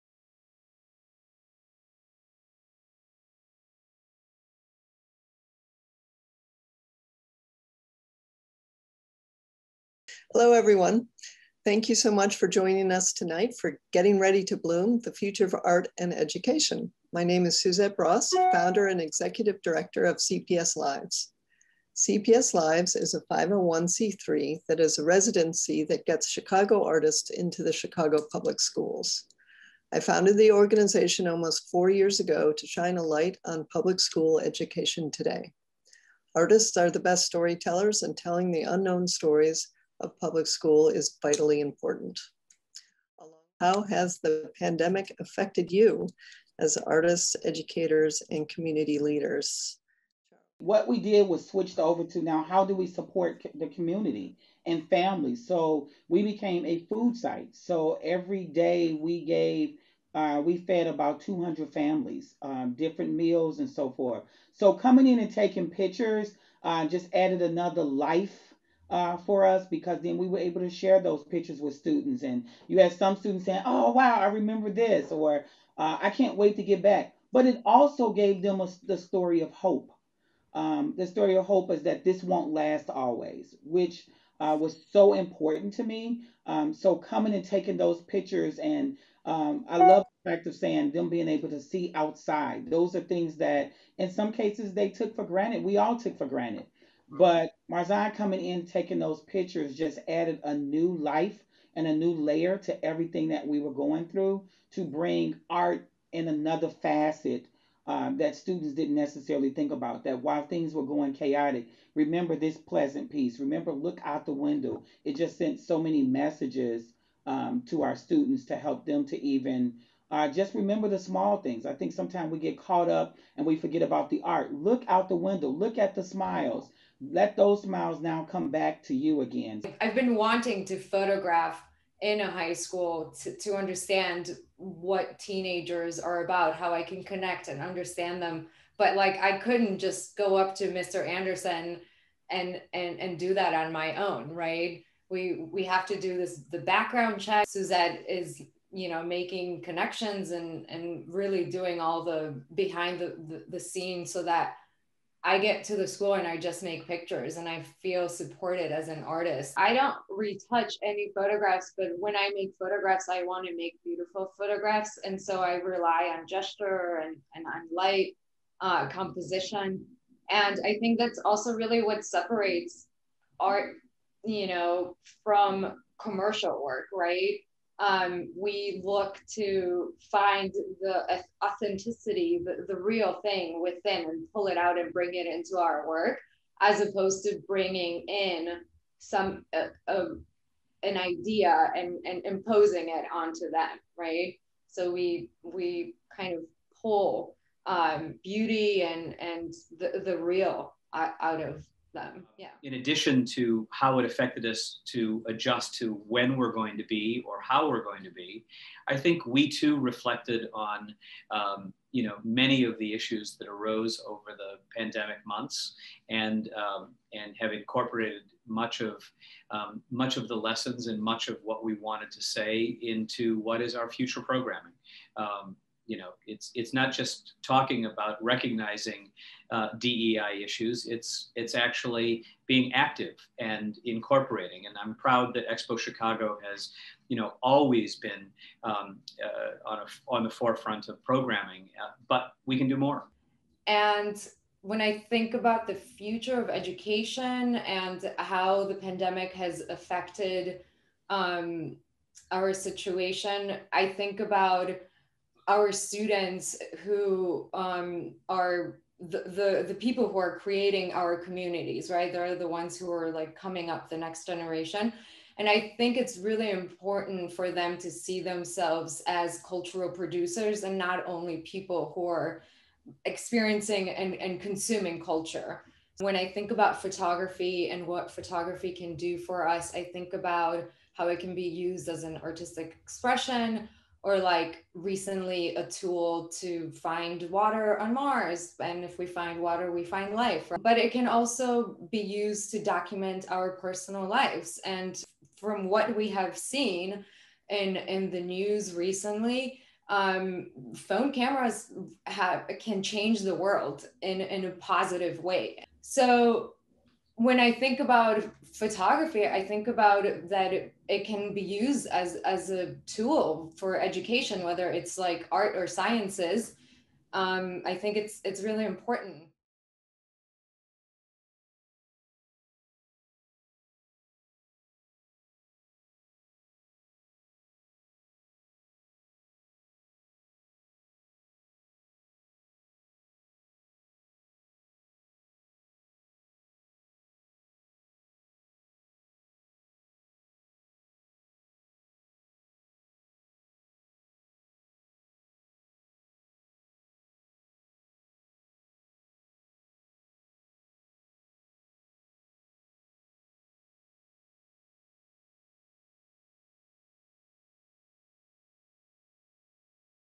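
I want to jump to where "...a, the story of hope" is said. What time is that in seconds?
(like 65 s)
78 s.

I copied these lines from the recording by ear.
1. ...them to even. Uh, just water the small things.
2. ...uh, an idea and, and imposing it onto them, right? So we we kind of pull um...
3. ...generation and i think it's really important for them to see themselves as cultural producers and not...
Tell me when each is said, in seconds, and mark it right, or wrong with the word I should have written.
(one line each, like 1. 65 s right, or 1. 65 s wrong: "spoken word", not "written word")
1. 118 s wrong: "remember", not "water"
2. 189 s right
3. 264 s right.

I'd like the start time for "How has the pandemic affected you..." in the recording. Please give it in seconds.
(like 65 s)
43 s.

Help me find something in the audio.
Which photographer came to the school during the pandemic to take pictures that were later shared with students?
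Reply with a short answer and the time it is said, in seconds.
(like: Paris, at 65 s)
Marzai, at 97 s.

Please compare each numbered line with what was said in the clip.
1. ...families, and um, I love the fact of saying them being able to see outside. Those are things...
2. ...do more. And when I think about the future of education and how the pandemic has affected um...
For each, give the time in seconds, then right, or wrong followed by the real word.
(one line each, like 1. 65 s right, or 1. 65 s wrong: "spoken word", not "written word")
1. 88 s wrong: "pictures", not "families"
2. 242 s right.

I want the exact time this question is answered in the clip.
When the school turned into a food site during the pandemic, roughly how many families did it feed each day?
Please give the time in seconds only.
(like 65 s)
61 s.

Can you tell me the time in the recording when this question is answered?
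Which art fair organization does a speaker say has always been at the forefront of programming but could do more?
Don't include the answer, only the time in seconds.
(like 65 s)
235 s.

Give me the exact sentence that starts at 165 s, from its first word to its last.
And so I rely on gesture and, and on light, uh, composition.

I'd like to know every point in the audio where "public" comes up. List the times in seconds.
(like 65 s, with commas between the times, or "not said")
28 s, 33 s, 40 s.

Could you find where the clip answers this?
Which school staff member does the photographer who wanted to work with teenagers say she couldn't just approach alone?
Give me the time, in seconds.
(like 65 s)
140 s.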